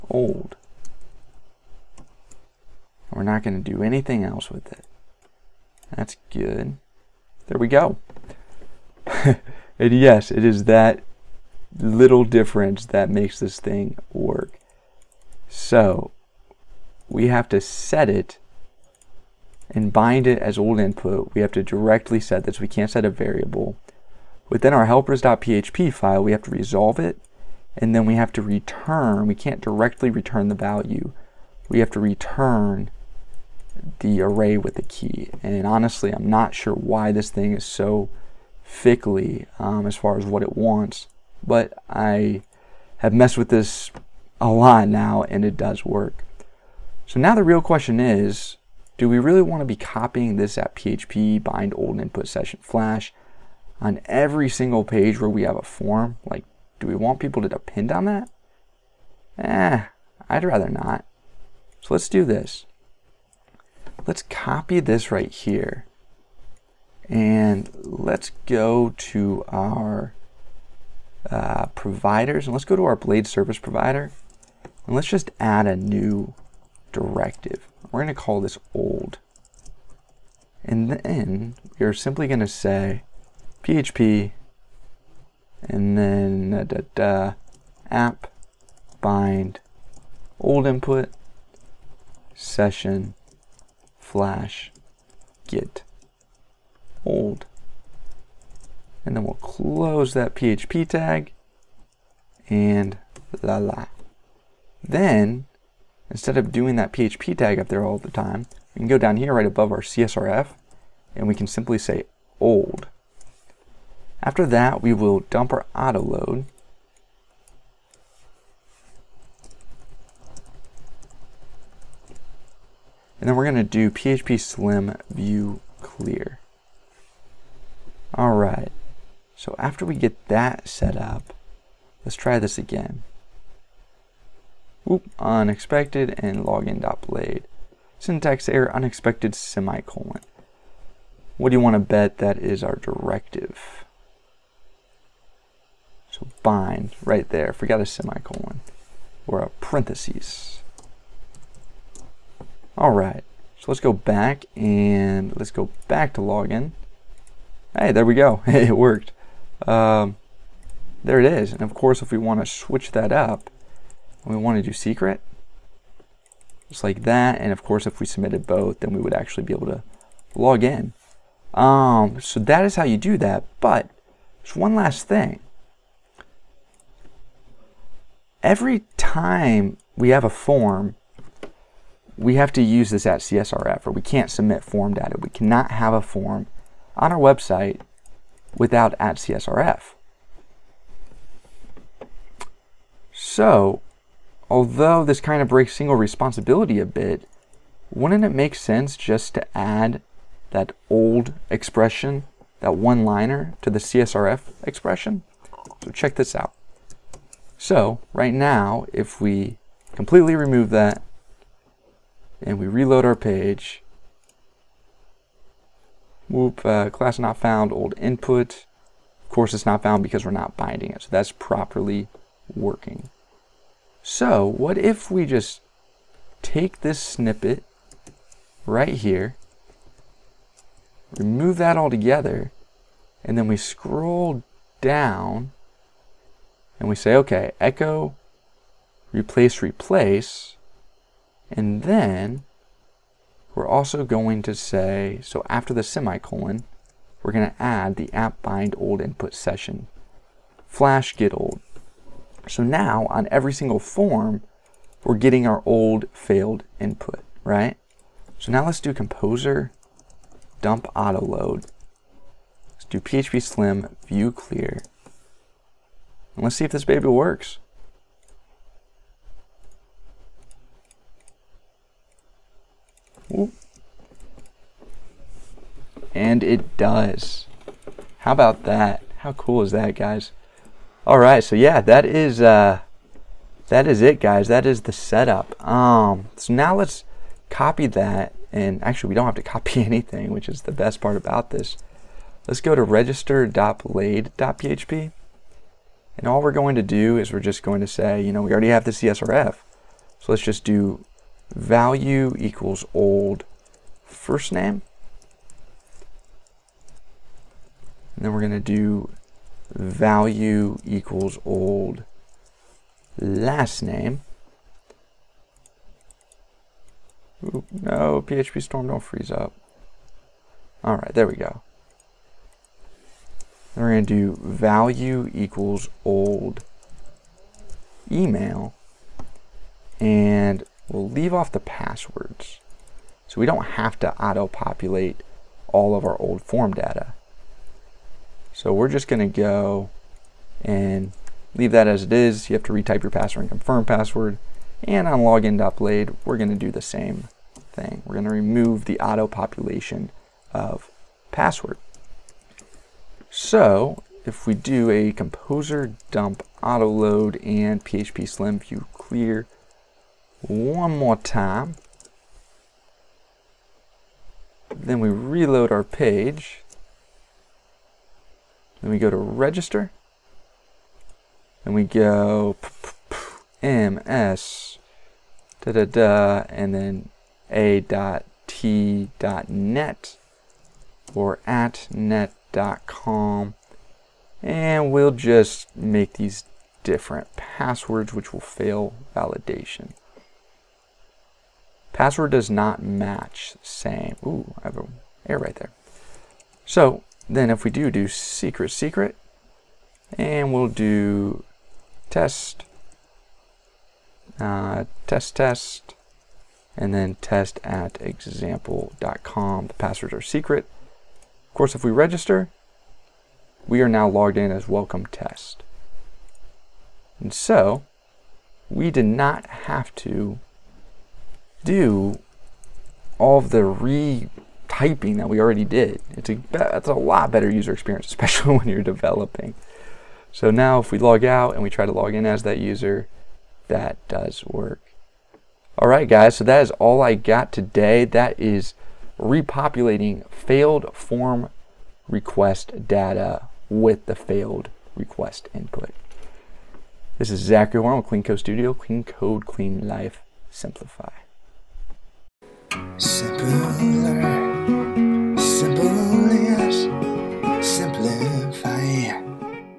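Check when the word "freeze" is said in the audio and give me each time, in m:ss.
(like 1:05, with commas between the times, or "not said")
5:18.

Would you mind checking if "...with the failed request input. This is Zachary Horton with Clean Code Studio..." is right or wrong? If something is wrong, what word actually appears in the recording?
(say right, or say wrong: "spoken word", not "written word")
right.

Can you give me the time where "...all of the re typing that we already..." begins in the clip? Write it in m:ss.
7:03.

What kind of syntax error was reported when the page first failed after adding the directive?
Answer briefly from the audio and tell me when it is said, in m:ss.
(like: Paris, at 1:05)
unexpected semicolon, at 2:18.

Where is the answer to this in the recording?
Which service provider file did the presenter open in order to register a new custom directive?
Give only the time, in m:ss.
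1:12.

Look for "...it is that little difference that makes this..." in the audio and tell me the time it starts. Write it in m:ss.
0:10.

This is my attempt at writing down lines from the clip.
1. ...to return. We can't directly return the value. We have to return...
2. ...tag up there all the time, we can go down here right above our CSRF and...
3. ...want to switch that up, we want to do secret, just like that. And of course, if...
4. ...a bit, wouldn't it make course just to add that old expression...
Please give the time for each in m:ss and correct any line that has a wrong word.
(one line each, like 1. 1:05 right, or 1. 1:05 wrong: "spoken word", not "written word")
1. 0:28 right
2. 1:47 right
3. 2:42 right
4. 3:16 wrong: "sense", not "course".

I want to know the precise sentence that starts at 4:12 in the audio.
So now on every single form, we're getting our old failed input, right?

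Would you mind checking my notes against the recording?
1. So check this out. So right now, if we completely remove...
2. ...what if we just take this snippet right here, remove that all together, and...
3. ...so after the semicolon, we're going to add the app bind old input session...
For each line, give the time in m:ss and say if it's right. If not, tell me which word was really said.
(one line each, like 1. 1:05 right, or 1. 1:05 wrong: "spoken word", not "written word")
1. 3:25 right
2. 3:44 right
3. 4:05 right.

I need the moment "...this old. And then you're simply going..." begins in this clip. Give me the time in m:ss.
1:18.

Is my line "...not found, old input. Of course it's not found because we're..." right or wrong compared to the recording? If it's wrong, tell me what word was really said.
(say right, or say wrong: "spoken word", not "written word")
right.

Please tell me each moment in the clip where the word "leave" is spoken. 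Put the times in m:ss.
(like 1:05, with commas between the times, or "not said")
5:31, 5:41.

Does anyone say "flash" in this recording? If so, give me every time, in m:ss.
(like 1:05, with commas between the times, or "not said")
0:52, 1:33, 4:10.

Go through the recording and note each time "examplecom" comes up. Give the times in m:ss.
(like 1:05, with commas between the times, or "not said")
6:48.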